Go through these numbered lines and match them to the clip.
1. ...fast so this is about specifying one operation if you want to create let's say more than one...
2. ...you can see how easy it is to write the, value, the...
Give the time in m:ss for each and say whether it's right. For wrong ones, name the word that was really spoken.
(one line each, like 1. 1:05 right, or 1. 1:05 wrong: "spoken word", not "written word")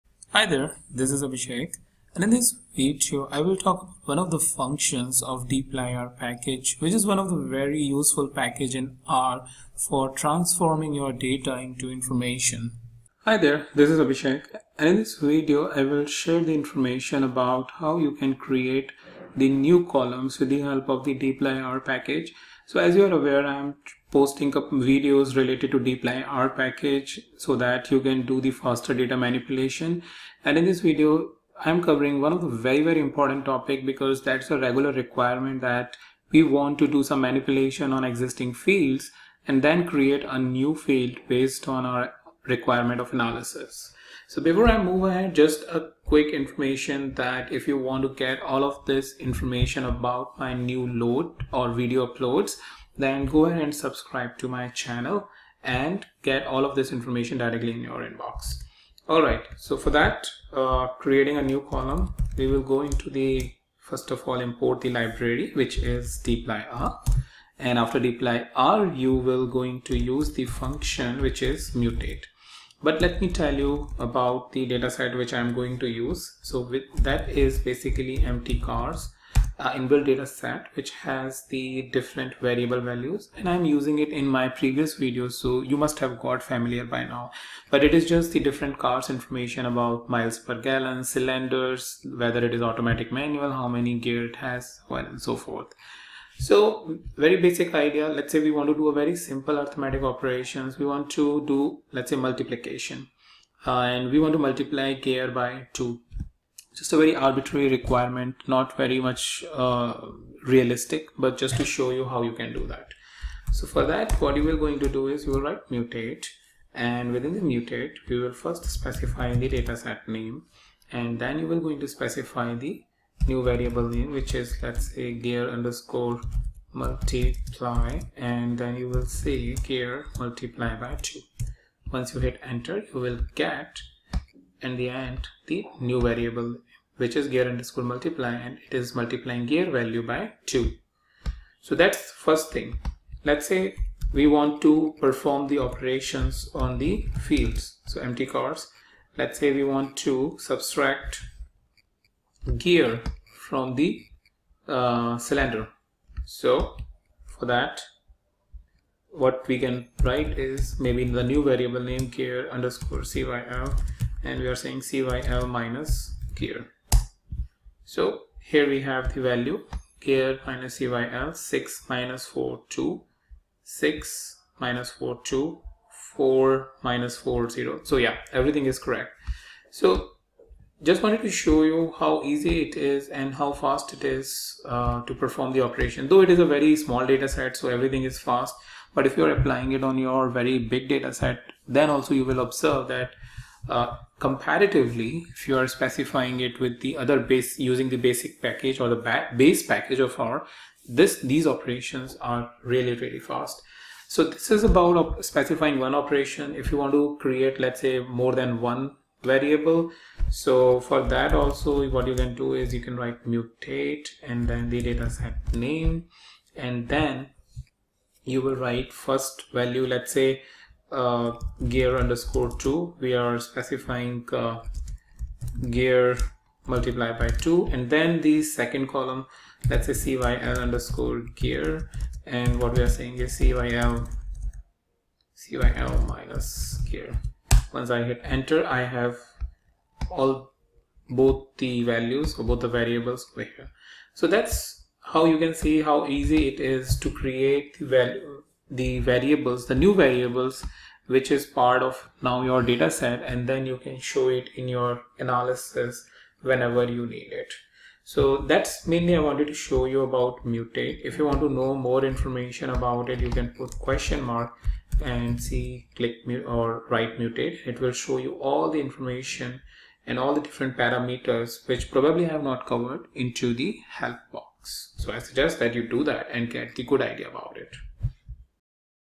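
1. 3:23 right
2. 4:05 wrong: "create", not "write".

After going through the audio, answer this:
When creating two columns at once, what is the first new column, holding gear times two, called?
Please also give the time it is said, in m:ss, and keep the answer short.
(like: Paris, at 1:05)
gear_2, at 3:41.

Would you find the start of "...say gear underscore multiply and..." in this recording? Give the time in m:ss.
2:04.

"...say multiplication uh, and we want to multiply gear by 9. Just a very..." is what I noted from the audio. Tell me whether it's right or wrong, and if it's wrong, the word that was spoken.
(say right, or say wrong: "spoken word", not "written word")
wrong: "2", not "9".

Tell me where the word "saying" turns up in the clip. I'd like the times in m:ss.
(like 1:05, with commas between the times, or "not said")
2:44, 3:52.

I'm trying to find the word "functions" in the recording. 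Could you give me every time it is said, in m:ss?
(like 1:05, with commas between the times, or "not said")
0:04, 1:10.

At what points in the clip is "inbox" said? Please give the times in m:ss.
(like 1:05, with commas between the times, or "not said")
0:58.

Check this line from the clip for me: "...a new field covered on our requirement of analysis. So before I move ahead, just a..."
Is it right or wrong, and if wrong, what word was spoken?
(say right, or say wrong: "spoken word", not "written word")
wrong: "based", not "covered".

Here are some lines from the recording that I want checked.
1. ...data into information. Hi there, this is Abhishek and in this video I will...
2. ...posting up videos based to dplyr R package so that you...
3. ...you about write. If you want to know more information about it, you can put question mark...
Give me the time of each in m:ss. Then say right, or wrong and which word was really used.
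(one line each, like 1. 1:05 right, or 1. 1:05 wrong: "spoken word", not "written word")
1. 0:11 right
2. 0:24 wrong: "related", not "based"
3. 4:19 wrong: "mutate", not "write".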